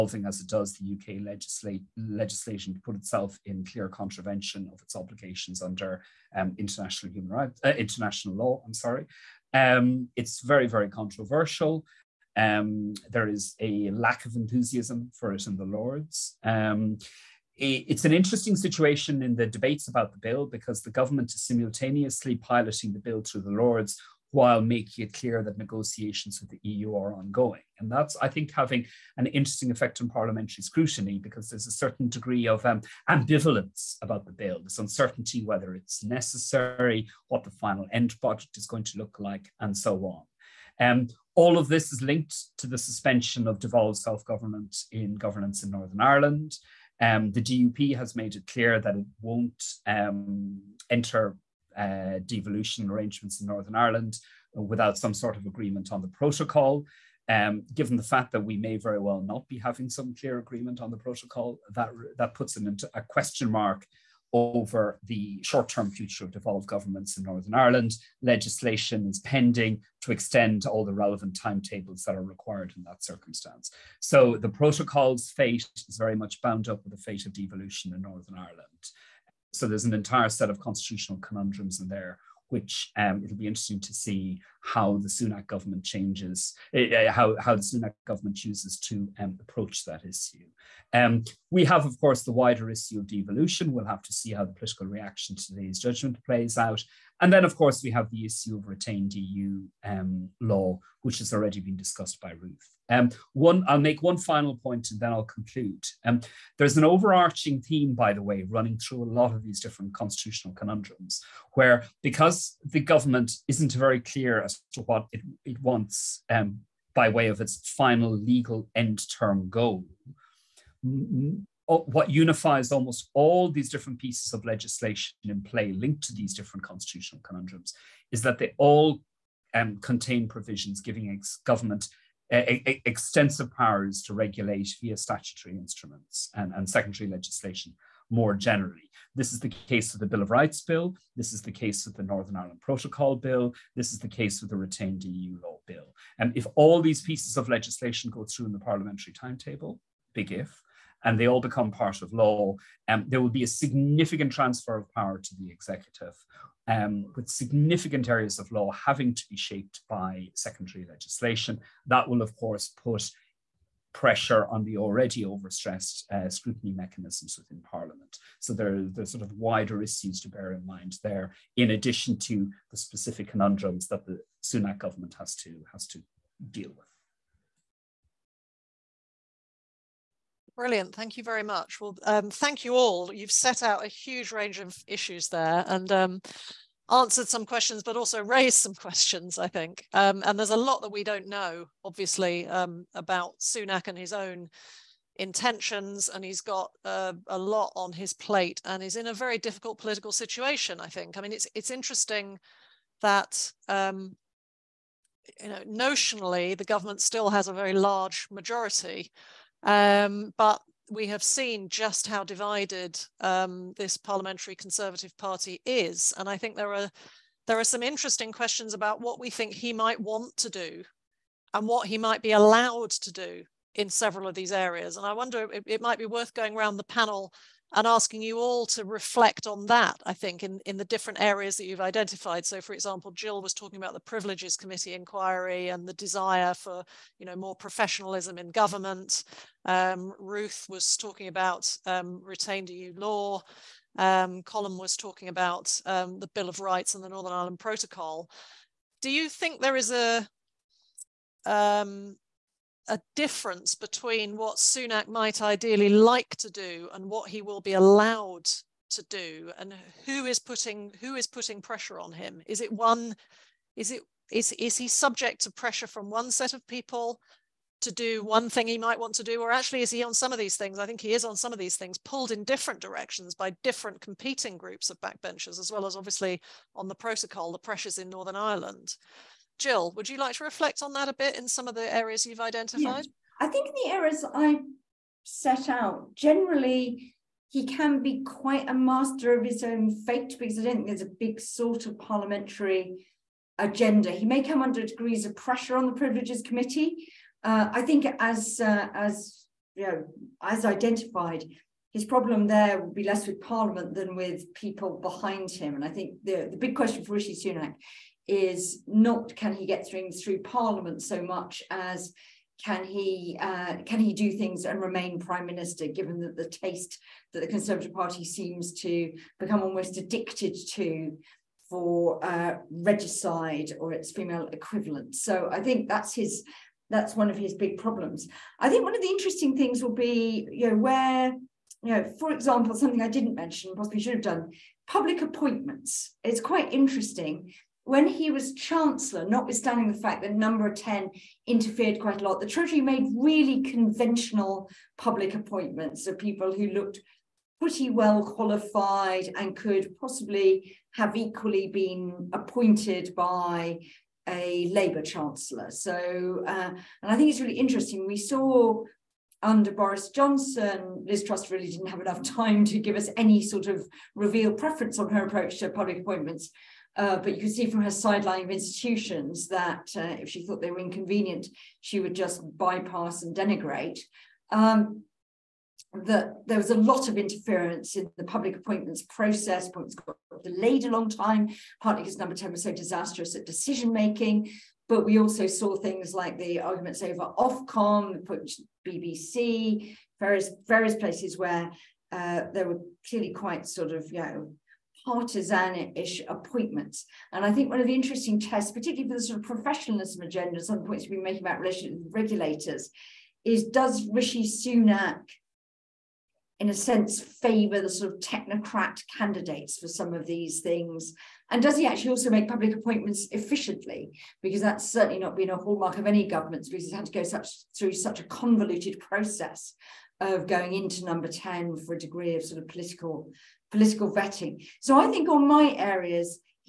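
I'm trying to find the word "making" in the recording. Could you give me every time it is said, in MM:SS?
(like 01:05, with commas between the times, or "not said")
00:24, 06:23, 06:41.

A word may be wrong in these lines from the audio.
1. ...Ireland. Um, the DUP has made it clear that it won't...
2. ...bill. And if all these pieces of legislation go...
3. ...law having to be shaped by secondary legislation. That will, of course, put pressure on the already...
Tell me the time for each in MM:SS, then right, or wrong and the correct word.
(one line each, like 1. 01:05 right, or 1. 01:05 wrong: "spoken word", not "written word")
1. 00:46 right
2. 02:25 right
3. 02:38 right.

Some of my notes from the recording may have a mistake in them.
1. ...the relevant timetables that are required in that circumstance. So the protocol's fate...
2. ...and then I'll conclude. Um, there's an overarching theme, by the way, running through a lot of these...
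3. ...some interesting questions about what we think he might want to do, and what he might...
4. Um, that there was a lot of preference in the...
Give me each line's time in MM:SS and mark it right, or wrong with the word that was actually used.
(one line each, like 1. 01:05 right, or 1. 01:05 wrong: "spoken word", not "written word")
1. 01:10 right
2. 01:44 right
3. 03:37 right
4. 06:14 wrong: "interference", not "preference".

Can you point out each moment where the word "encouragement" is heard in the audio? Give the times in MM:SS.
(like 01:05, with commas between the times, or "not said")
not said.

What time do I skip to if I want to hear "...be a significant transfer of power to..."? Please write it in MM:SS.
02:33.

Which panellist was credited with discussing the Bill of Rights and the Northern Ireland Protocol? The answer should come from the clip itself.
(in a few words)
Colm.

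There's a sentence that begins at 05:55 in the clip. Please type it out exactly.
So, uh, and I think it's really interesting.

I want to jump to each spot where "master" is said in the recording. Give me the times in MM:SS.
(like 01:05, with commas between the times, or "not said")
04:48.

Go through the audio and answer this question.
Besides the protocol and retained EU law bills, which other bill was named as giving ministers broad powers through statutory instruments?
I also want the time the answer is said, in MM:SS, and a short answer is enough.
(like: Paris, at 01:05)
Bill of Rights Bill, at 02:20.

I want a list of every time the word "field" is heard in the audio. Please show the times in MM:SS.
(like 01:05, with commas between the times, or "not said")
not said.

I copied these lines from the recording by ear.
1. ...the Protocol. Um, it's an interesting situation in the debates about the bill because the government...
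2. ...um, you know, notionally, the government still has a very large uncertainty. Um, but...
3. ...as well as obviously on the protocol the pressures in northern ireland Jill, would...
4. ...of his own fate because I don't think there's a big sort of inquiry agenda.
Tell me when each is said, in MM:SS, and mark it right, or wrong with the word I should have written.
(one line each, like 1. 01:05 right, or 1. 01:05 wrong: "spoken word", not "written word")
1. 00:15 wrong: "Lords", not "Protocol"
2. 03:23 wrong: "majority", not "uncertainty"
3. 04:35 right
4. 04:49 wrong: "parliamentary", not "inquiry".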